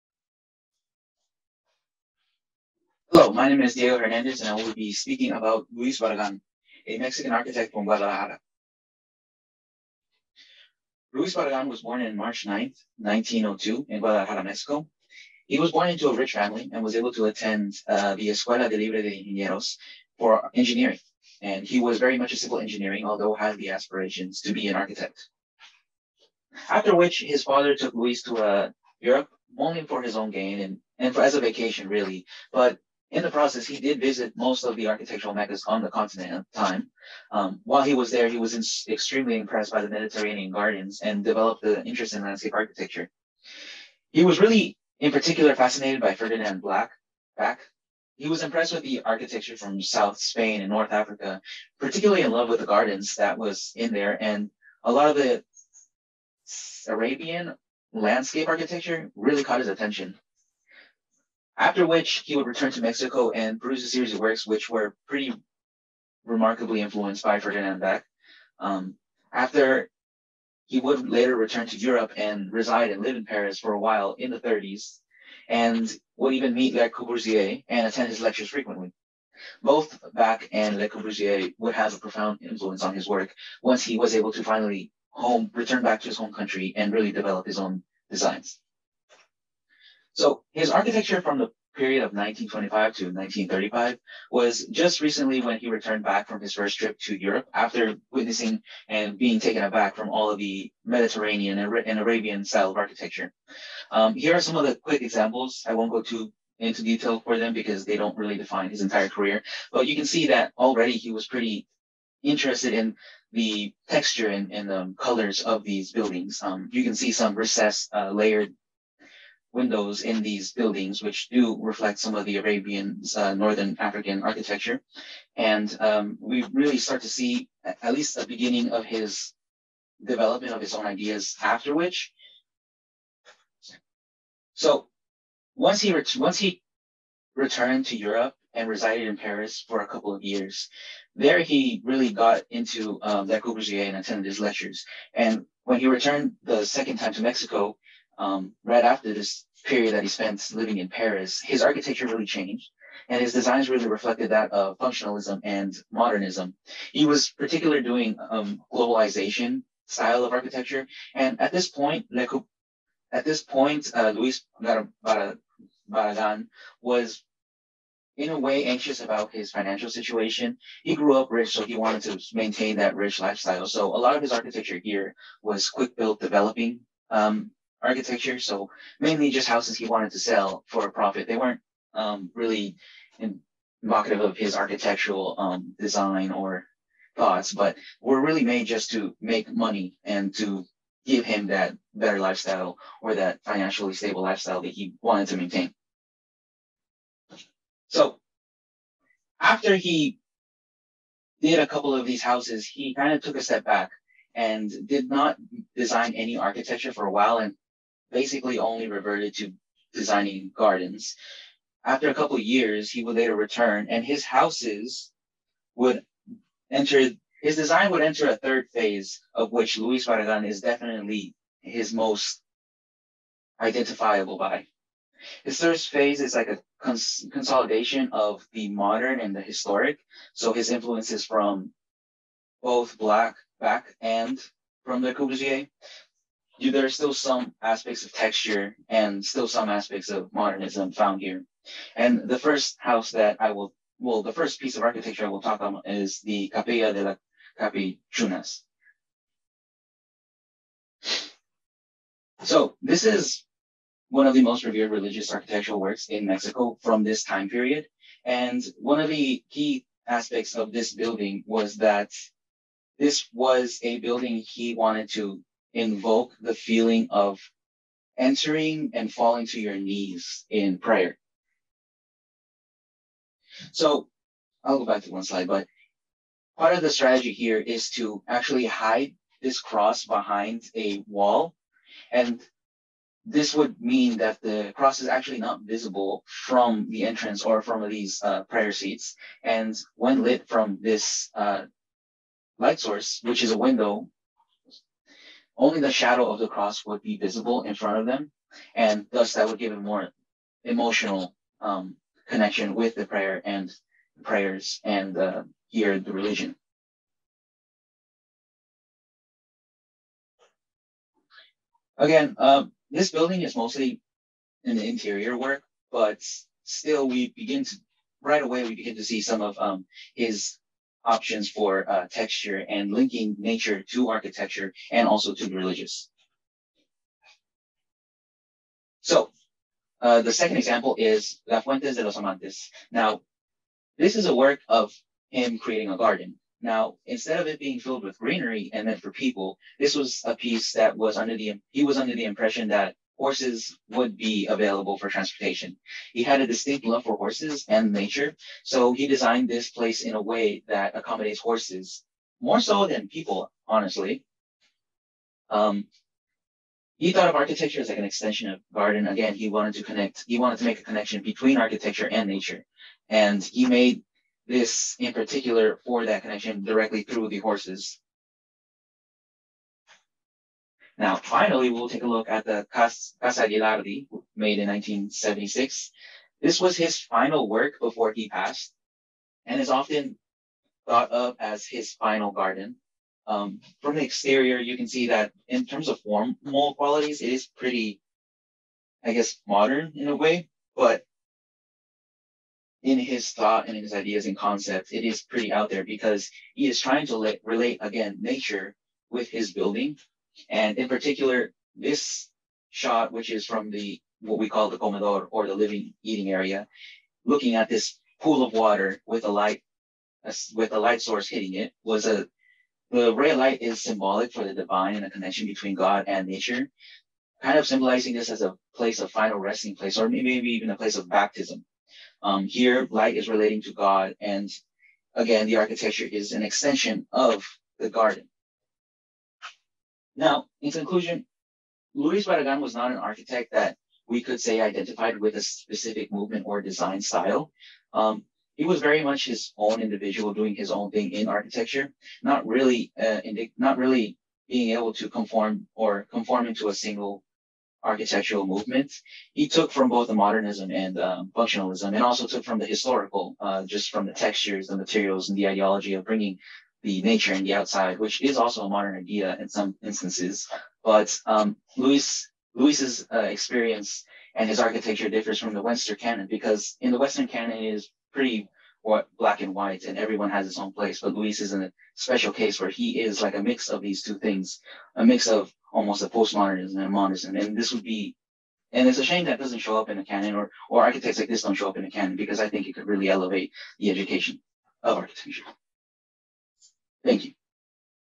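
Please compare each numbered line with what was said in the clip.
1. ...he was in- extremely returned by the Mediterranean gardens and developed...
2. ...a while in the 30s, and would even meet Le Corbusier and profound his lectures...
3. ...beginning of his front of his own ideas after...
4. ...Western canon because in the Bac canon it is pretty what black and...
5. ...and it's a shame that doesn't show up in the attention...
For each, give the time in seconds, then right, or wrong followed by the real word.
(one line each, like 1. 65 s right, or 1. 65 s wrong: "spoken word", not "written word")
1. 38 s wrong: "impressed", not "returned"
2. 73 s wrong: "attend", not "profound"
3. 128 s wrong: "development", not "front"
4. 465 s wrong: "Western", not "Bac"
5. 478 s wrong: "canon", not "attention".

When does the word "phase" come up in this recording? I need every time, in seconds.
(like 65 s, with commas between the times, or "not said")
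218 s, 225 s.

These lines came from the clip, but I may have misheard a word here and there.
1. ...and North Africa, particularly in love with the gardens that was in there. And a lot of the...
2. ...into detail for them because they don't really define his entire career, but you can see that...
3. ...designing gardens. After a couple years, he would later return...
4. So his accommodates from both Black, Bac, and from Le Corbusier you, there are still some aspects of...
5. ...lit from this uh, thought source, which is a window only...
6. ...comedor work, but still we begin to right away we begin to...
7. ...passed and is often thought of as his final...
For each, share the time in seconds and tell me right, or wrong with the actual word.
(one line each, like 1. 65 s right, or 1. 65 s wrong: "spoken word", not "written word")
1. 50 s right
2. 106 s right
3. 209 s right
4. 230 s wrong: "influences", not "accommodates"
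5. 290 s wrong: "light", not "thought"
6. 314 s wrong: "interior", not "comedor"
7. 378 s right.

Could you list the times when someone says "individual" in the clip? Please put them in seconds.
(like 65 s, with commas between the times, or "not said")
439 s.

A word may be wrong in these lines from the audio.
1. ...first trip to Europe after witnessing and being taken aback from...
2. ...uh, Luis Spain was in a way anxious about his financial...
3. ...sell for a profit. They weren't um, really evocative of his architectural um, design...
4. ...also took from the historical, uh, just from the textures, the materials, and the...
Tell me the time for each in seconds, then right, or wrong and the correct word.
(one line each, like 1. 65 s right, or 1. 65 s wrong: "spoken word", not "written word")
1. 96 s right
2. 163 s wrong: "Barragan", not "Spain"
3. 180 s right
4. 452 s right.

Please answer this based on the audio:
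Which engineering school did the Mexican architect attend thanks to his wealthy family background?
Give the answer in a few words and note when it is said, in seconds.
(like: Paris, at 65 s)
Escuela de Libre de Ingenieros, at 18 s.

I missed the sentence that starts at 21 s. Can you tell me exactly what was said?
And he was very much a civil engineering, although had the aspirations to be an architect.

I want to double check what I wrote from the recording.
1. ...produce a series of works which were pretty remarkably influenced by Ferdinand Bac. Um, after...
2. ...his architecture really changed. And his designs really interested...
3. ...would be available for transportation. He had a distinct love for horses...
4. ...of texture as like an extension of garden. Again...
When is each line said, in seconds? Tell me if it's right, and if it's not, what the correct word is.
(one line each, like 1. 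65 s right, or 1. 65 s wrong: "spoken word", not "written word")
1. 63 s right
2. 151 s wrong: "reflected", not "interested"
3. 343 s right
4. 357 s wrong: "architecture", not "texture".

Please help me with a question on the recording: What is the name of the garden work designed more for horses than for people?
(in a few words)
La Fuentes de los Amantes.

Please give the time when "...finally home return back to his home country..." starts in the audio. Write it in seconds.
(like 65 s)
84 s.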